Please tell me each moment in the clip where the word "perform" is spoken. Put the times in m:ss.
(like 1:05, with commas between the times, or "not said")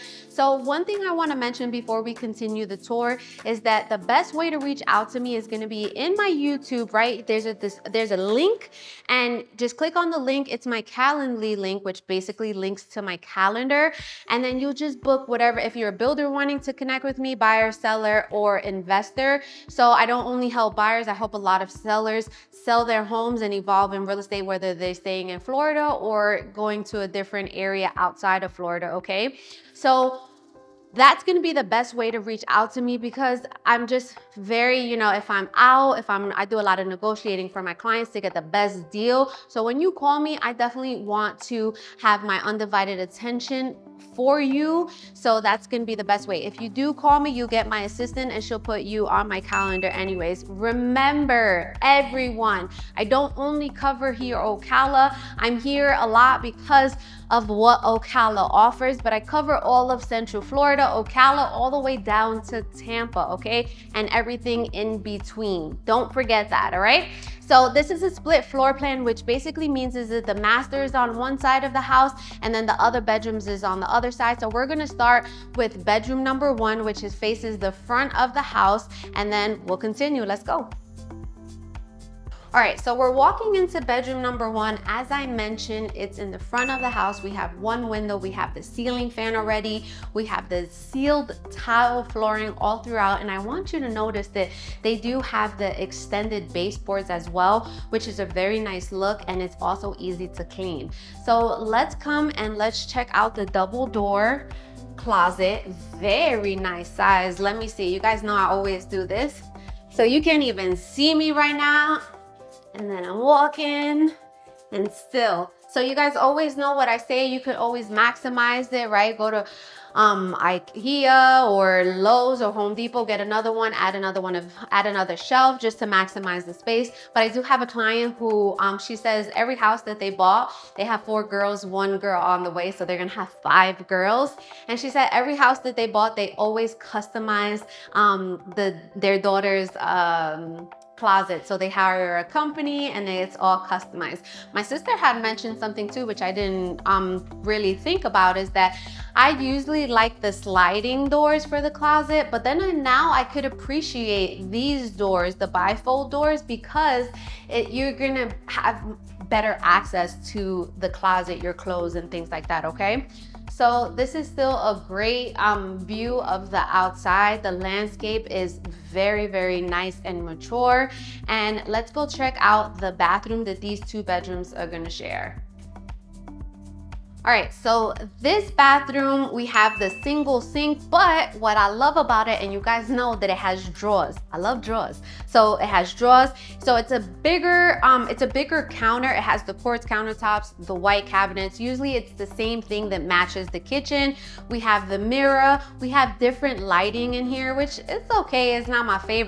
not said.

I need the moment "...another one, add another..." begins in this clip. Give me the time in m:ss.
2:03.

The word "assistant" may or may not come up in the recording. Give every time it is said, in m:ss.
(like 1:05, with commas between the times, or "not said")
0:47.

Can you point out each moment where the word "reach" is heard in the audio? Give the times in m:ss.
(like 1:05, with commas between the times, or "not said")
0:04, 0:32.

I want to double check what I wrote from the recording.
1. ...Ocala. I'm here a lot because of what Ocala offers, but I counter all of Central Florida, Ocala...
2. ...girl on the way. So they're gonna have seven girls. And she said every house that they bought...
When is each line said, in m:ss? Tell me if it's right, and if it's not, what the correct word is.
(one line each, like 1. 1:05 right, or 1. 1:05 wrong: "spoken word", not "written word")
1. 0:54 wrong: "cover", not "counter"
2. 2:11 wrong: "five", not "seven".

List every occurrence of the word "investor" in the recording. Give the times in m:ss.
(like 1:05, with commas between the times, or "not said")
0:18.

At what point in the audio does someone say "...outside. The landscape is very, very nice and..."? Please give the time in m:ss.
2:46.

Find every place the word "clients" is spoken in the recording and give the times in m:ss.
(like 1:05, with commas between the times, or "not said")
0:37, 2:07.